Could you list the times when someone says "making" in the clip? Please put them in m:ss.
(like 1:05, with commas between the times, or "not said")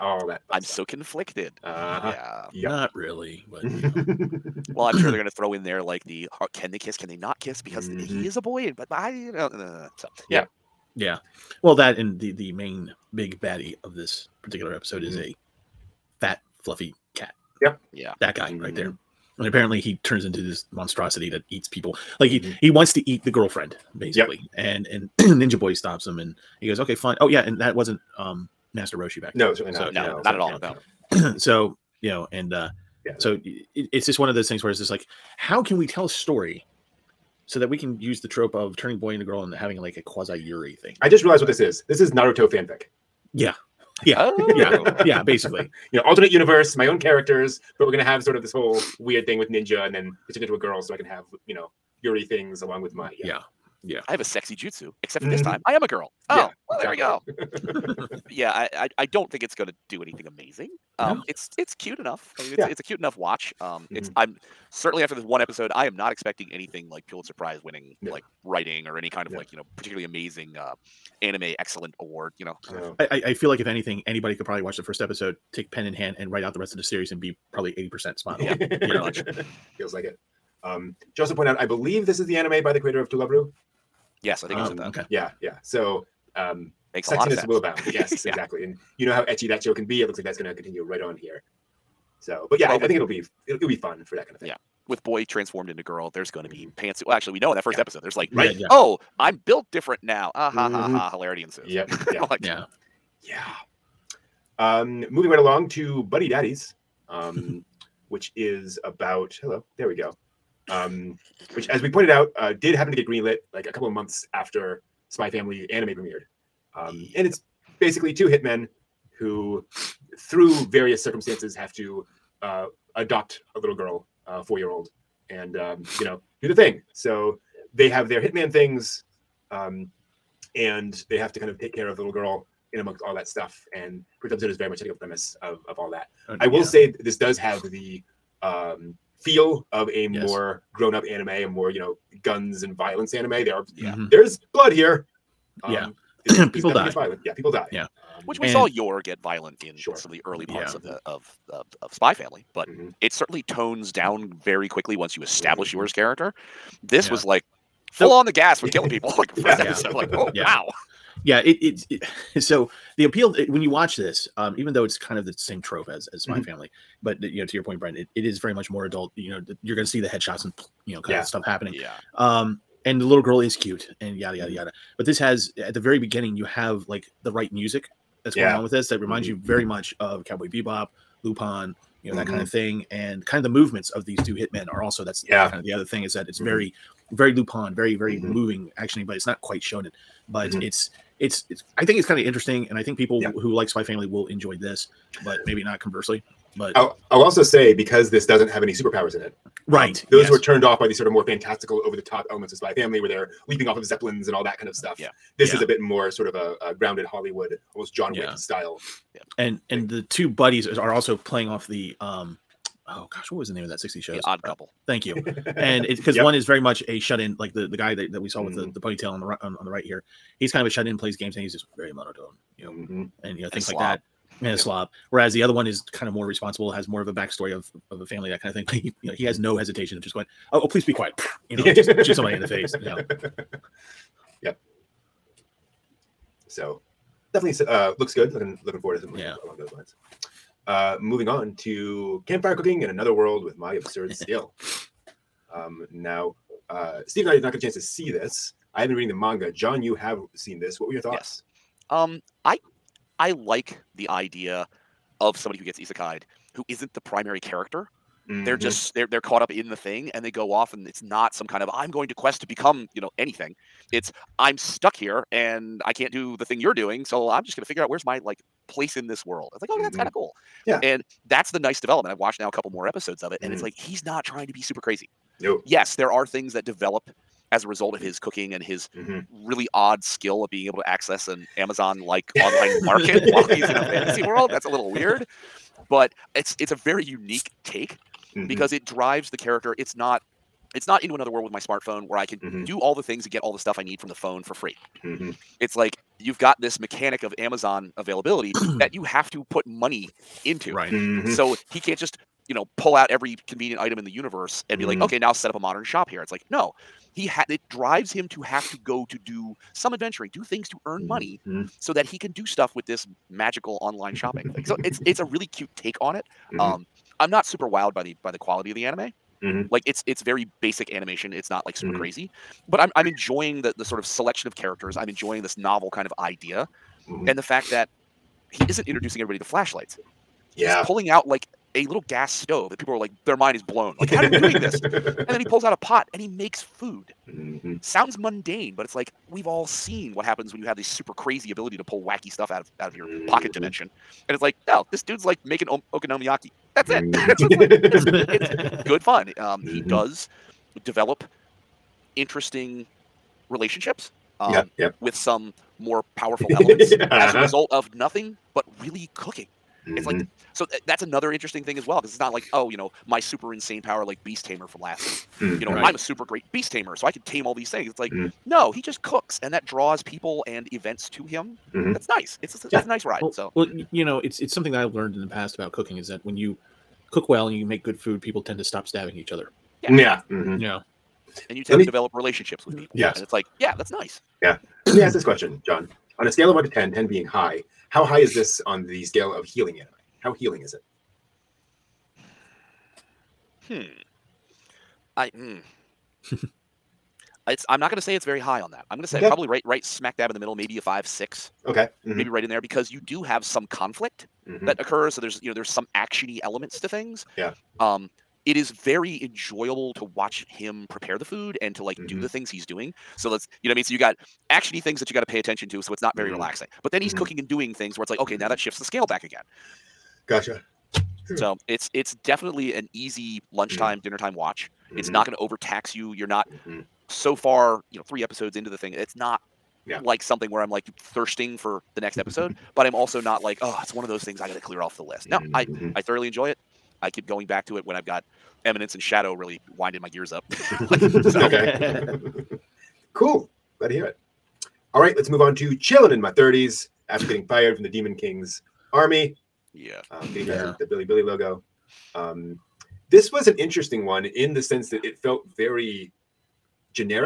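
5:45.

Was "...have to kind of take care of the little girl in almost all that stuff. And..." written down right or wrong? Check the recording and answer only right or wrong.
wrong.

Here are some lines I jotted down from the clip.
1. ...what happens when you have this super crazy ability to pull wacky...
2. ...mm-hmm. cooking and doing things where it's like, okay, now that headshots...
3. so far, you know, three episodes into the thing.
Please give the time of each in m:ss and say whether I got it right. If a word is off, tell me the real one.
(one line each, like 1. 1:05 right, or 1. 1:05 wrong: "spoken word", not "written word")
1. 5:40 right
2. 6:57 wrong: "shifts", not "headshots"
3. 7:07 right.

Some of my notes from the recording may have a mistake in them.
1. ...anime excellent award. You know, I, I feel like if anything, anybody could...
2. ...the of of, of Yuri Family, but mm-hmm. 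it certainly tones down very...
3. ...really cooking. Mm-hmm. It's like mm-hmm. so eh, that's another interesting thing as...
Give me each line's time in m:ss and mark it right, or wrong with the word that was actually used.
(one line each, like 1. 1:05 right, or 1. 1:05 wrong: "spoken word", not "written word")
1. 1:11 right
2. 2:30 wrong: "Spy", not "Yuri"
3. 5:58 right.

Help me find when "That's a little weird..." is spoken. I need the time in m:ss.
4:44.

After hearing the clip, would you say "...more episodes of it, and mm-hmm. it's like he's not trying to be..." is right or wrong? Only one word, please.
right.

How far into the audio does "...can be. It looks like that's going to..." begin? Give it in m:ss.
1:29.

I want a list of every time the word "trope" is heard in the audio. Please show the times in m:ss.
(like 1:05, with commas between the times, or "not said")
0:38, 2:45.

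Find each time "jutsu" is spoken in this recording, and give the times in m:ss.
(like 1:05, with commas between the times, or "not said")
0:54.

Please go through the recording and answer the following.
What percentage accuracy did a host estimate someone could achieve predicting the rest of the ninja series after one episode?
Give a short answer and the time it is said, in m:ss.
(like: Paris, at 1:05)
80, at 1:17.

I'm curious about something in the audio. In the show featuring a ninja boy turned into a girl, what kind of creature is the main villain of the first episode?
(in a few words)
A fat, fluffy cat.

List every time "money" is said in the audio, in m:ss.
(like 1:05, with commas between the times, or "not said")
4:59, 5:11.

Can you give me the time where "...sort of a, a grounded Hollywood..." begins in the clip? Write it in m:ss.
3:26.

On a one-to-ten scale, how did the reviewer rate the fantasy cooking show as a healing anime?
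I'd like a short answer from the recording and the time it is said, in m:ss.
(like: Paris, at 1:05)
5 to 6, at 6:40.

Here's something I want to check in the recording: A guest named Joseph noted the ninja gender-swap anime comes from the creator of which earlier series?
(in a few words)
To Love-Ru.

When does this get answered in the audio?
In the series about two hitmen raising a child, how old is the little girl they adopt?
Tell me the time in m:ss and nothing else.
2:04.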